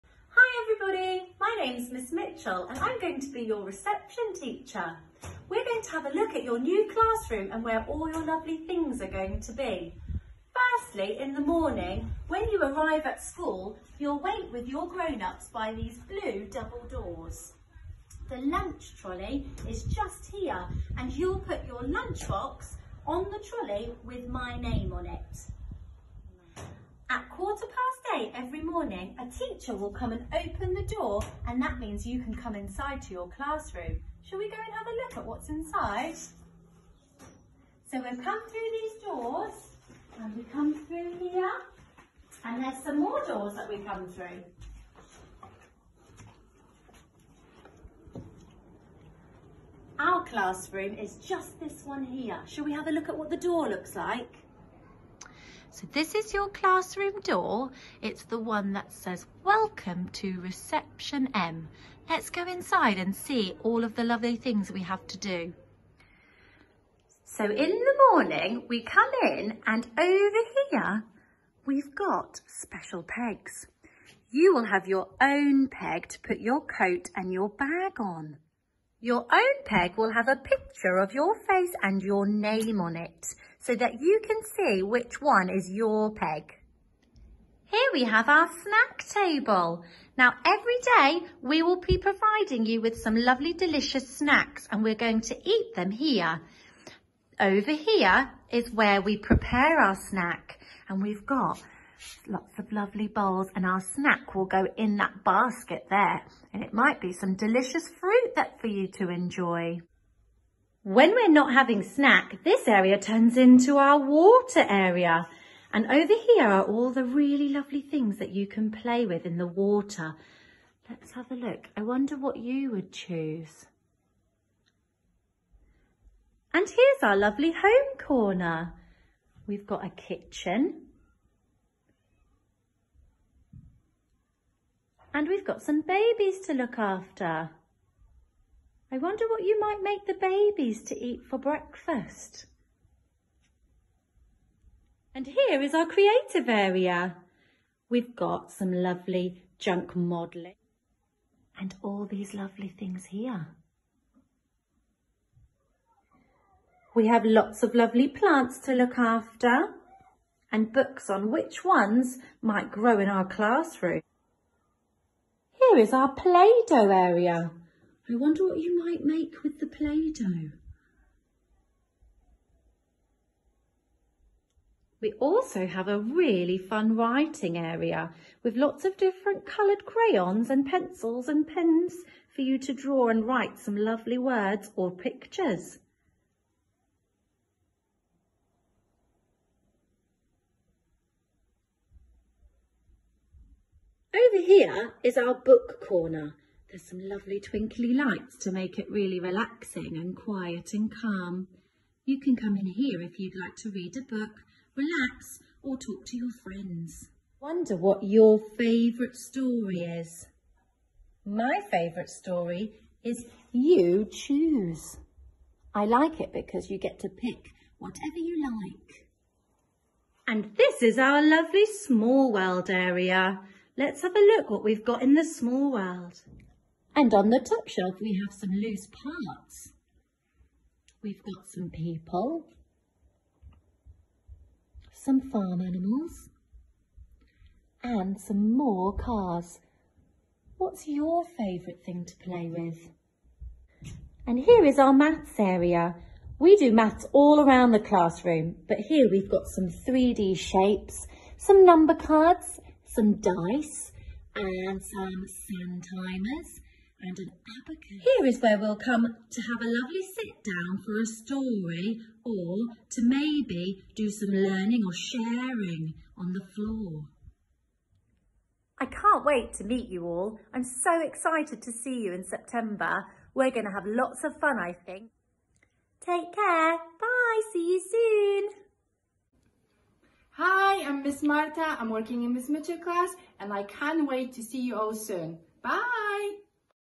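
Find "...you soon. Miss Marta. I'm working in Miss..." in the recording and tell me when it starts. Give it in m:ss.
4:37.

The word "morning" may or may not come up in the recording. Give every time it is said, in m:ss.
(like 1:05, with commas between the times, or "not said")
0:11, 0:28, 1:08.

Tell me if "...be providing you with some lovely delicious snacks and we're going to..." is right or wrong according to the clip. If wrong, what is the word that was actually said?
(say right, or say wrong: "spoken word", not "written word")
right.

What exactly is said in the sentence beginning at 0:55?
So this is your classroom door.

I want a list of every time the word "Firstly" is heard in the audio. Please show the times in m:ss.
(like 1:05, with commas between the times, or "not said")
0:10.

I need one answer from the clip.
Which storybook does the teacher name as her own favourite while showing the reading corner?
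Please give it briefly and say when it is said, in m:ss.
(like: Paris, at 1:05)
You Choose, at 3:33.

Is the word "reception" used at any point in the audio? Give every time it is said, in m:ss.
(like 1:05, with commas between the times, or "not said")
0:03, 1:00.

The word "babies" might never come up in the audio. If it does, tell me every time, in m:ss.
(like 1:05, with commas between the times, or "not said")
2:15, 2:20.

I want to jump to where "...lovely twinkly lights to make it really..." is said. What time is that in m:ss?
3:17.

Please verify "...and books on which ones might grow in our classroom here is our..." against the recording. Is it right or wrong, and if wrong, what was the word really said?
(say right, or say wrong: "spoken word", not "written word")
right.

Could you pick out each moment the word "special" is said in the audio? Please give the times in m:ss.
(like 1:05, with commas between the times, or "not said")
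1:12.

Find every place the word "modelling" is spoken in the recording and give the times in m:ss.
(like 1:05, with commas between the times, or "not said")
2:29.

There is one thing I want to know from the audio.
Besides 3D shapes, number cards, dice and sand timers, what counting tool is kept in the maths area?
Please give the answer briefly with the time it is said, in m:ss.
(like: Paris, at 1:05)
Abacus, at 4:17.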